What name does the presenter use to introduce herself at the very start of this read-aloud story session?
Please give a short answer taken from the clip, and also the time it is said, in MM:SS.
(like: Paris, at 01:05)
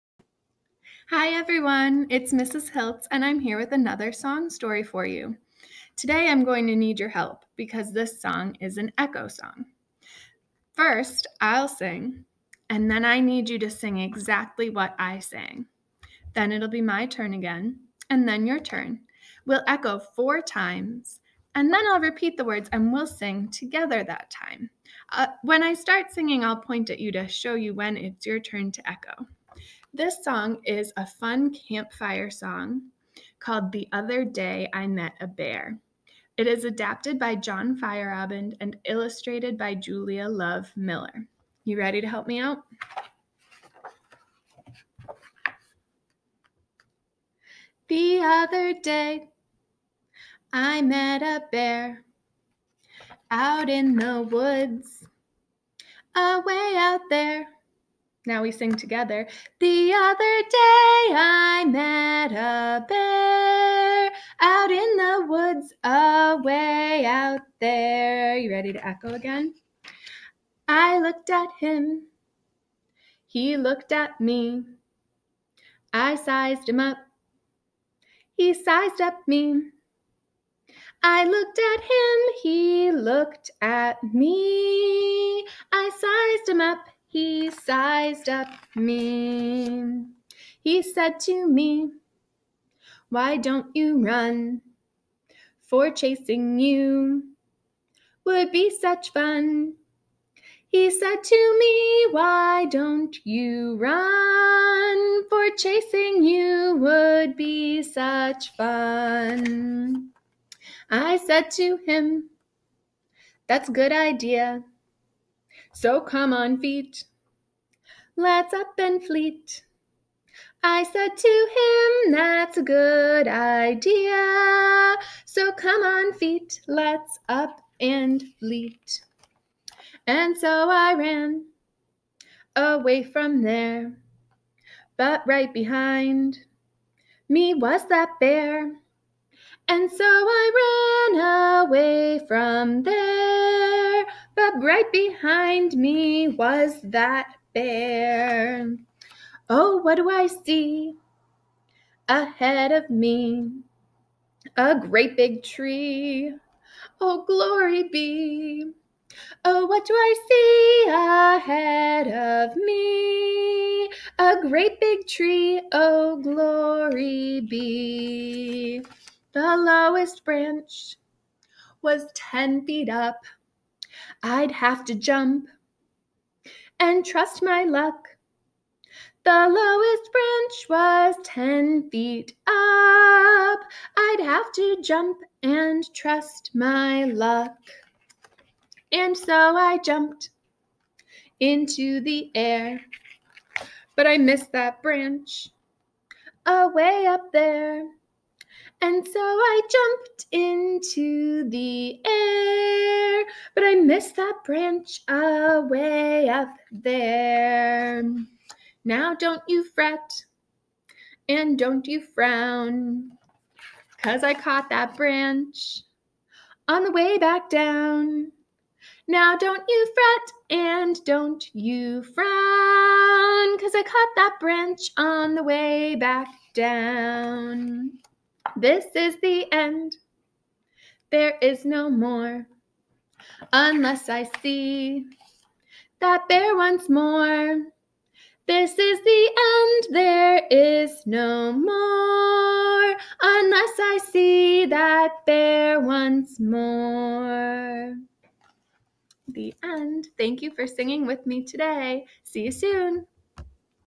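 Mrs. Hilts, at 00:02.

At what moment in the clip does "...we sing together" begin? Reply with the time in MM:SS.
00:58.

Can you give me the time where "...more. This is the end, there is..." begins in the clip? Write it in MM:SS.
03:56.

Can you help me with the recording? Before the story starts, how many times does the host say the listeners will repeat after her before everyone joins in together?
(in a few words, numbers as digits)
4.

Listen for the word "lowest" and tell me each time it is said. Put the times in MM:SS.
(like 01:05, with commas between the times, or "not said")
02:49, 02:59.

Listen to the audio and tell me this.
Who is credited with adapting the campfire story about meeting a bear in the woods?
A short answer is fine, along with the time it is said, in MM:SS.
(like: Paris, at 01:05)
John Feierabend, at 00:37.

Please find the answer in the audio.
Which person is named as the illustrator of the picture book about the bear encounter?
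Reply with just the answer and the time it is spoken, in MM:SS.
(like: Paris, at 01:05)
Julia Love Miller, at 00:39.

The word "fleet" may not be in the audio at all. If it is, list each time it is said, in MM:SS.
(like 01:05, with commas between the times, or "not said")
01:59, 02:08.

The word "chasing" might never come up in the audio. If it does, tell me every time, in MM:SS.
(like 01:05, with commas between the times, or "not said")
01:35, 01:45.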